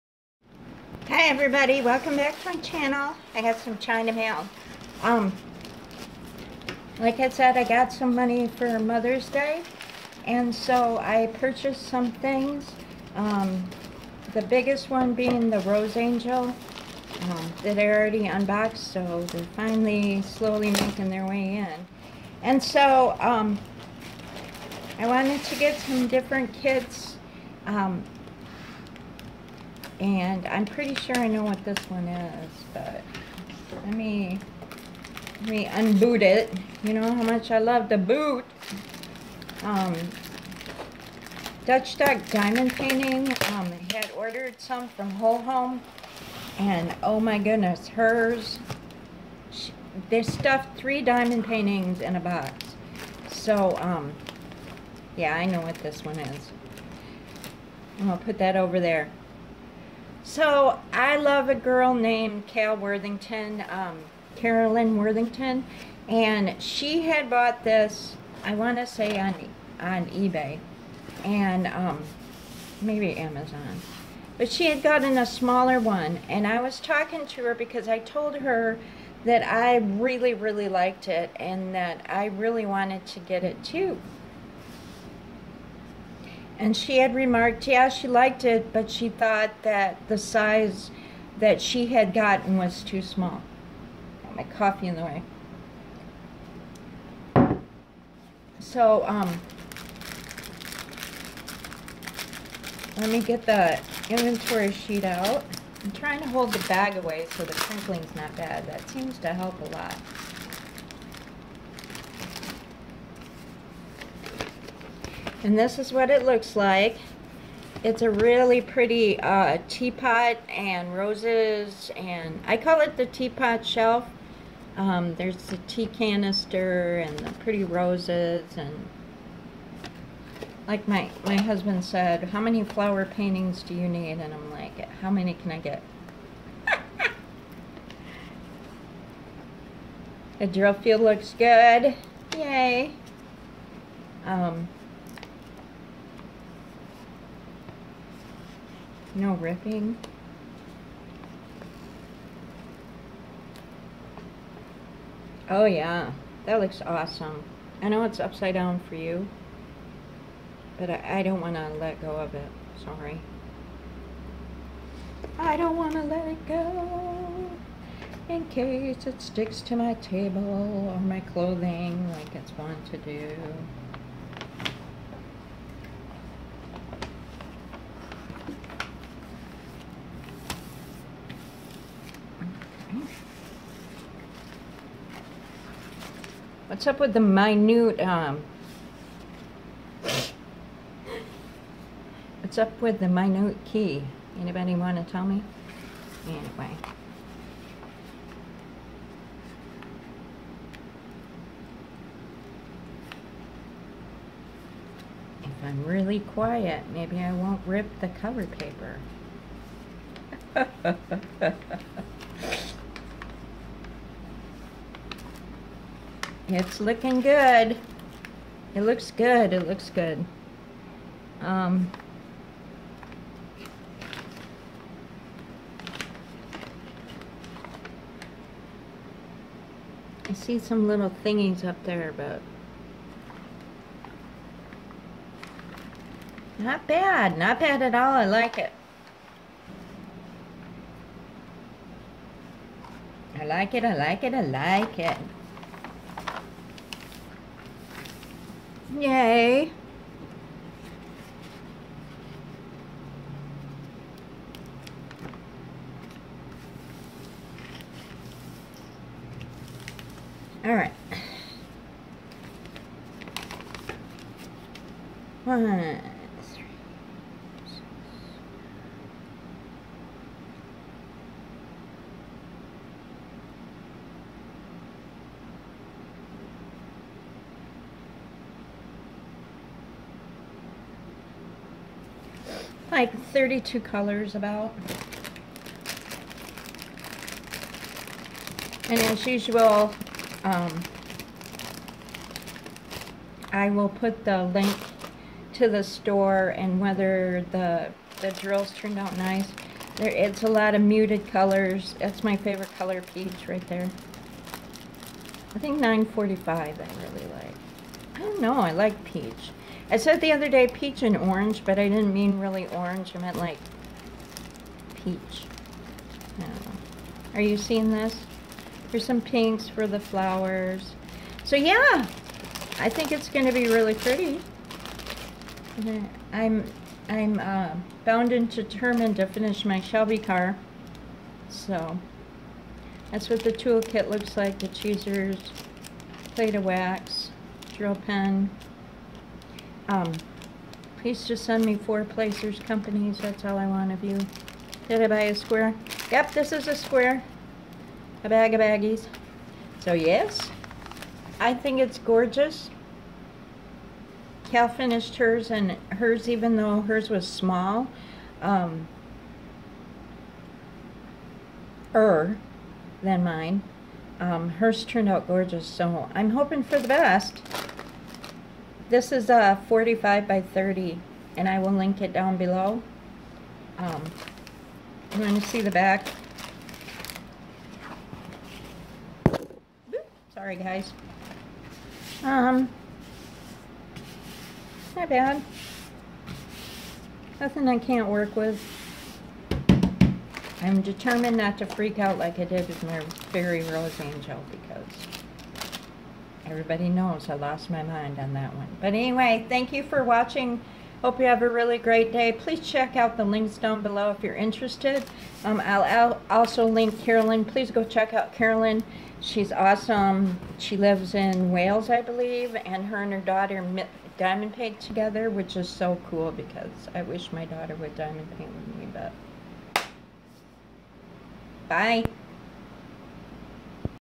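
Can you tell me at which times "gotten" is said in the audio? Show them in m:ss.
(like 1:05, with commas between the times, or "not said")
1:14, 1:32.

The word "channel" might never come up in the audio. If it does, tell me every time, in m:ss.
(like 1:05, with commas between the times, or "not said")
0:02.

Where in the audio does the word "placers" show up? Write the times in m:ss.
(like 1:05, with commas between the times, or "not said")
5:42.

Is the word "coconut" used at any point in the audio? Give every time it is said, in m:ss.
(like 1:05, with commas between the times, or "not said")
not said.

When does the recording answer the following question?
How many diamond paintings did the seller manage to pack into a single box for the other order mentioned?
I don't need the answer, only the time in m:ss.
0:50.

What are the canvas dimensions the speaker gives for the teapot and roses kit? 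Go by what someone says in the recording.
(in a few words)
45 by 30.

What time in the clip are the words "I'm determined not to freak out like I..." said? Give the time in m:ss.
6:30.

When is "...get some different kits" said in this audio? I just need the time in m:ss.
0:25.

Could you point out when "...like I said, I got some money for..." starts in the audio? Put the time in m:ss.
0:07.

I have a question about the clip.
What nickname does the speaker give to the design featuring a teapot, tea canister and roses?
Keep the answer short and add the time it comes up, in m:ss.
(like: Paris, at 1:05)
the teapot shelf, at 2:02.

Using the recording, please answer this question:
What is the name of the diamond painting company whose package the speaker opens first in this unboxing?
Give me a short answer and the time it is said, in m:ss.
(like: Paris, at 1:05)
Dutch Duck Diamond Painting, at 0:41.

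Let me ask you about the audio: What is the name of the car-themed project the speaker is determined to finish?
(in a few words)
Shelby car.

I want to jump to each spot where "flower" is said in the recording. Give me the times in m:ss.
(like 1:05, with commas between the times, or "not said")
2:12, 5:19.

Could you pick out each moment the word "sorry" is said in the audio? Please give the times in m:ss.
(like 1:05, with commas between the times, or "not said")
2:42, 6:20.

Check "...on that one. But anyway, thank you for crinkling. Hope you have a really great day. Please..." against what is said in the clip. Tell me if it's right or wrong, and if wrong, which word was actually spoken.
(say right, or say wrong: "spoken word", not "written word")
wrong: "watching", not "crinkling".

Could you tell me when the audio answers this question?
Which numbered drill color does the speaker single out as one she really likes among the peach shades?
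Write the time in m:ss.
5:05.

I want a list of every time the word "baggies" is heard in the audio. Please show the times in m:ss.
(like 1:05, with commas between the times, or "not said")
5:48.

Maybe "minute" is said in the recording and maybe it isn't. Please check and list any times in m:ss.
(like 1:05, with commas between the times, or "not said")
3:07, 3:13.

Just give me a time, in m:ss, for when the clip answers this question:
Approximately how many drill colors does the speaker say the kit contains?
4:43.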